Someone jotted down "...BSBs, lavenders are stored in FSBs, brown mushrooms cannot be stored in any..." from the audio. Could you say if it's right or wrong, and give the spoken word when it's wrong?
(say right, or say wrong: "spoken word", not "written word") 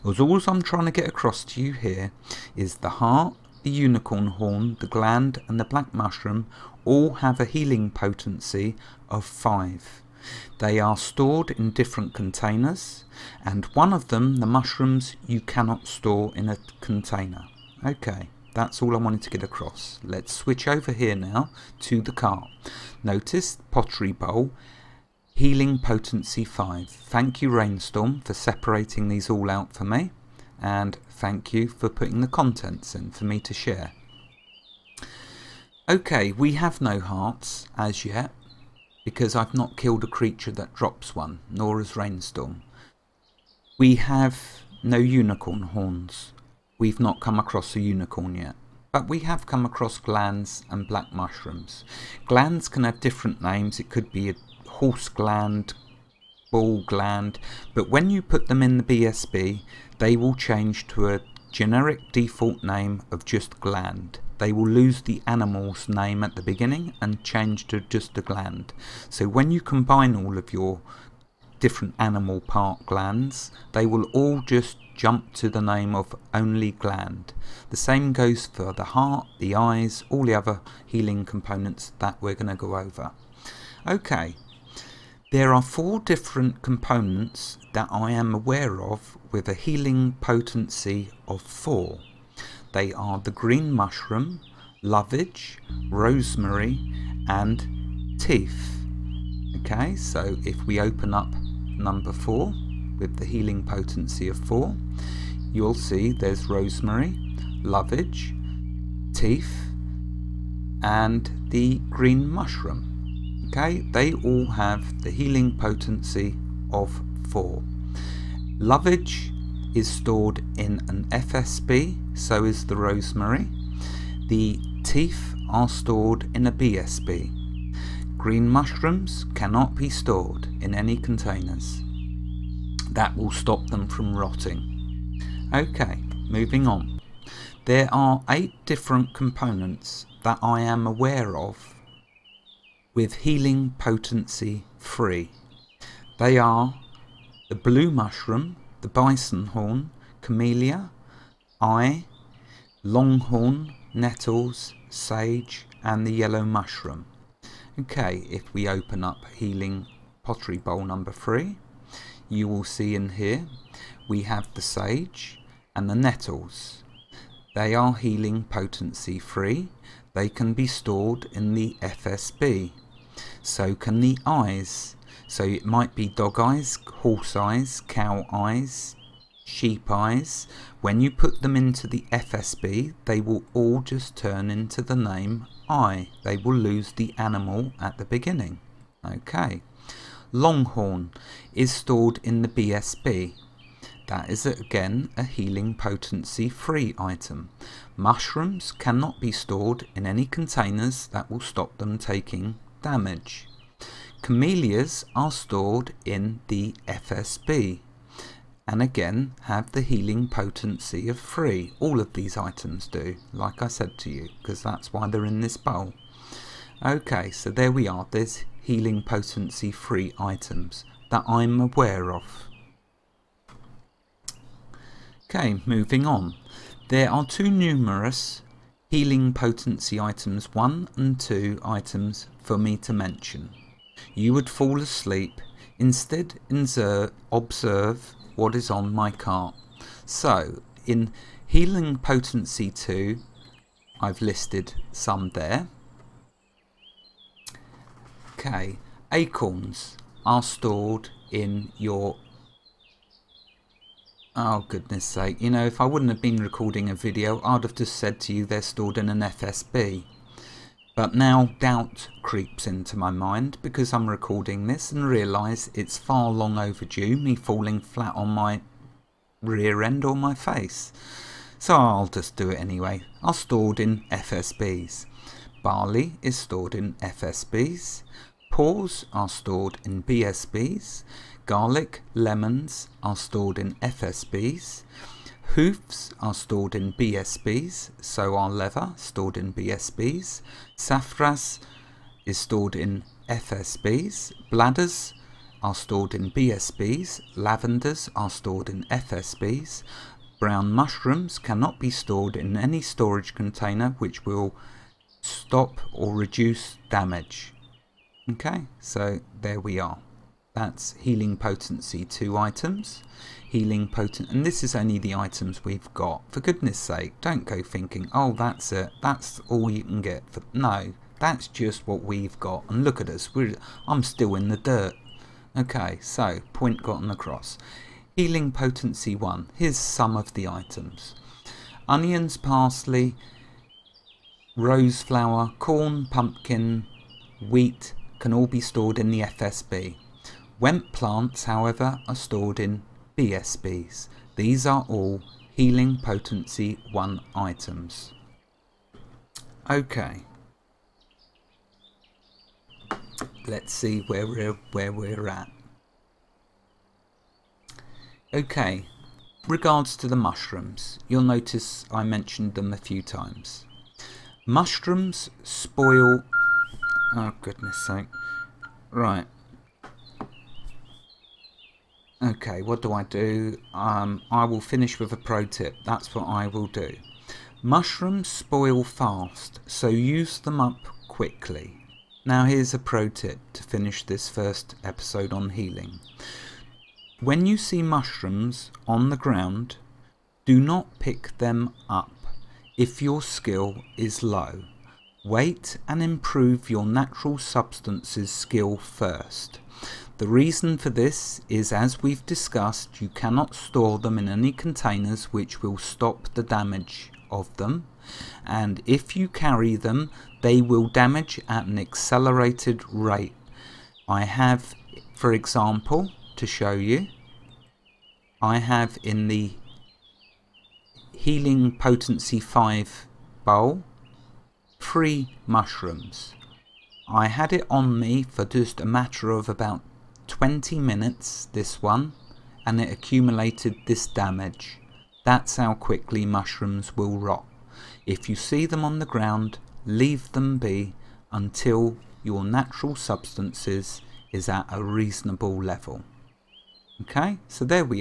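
right.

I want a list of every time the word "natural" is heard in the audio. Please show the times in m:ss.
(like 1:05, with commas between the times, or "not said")
6:36, 7:22.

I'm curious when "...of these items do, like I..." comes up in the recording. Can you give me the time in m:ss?
3:31.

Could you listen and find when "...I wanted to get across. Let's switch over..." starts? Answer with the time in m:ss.
0:18.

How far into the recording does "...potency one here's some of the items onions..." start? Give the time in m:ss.
5:28.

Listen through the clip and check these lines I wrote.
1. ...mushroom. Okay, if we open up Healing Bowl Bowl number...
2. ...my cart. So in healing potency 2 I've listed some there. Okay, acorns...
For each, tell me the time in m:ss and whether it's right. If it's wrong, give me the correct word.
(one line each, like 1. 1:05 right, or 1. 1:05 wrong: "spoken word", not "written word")
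1. 2:36 wrong: "Pottery", not "Bowl"
2. 3:58 right.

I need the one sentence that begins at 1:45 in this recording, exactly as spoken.
You'll see there's rosemary, lovage, teeth, and the green mushroom.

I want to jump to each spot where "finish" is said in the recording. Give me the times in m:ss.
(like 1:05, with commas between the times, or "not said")
6:14, 6:23.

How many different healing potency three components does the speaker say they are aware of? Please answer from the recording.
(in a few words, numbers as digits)
eight.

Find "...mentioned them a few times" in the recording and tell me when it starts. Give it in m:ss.
6:02.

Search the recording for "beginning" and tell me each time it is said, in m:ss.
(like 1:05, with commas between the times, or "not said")
1:06, 3:08.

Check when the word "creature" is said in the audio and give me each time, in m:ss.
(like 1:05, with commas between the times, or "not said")
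0:40.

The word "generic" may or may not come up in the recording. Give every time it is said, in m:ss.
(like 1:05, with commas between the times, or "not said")
1:01.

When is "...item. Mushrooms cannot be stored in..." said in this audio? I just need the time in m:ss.
3:16.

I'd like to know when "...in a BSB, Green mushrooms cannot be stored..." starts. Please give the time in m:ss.
2:06.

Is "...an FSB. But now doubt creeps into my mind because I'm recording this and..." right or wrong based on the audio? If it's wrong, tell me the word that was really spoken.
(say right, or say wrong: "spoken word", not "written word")
right.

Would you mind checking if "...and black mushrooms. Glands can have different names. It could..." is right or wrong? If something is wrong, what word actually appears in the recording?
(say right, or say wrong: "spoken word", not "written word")
right.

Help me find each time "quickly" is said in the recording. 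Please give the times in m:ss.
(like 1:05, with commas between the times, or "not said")
6:21, 7:15.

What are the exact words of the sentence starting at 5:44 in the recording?
These are all healing potency 1 items.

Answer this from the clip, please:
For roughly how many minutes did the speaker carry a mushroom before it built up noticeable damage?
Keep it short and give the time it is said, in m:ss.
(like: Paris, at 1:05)
20 minutes, at 7:09.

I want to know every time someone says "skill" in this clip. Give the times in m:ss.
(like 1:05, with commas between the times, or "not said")
6:33, 6:38.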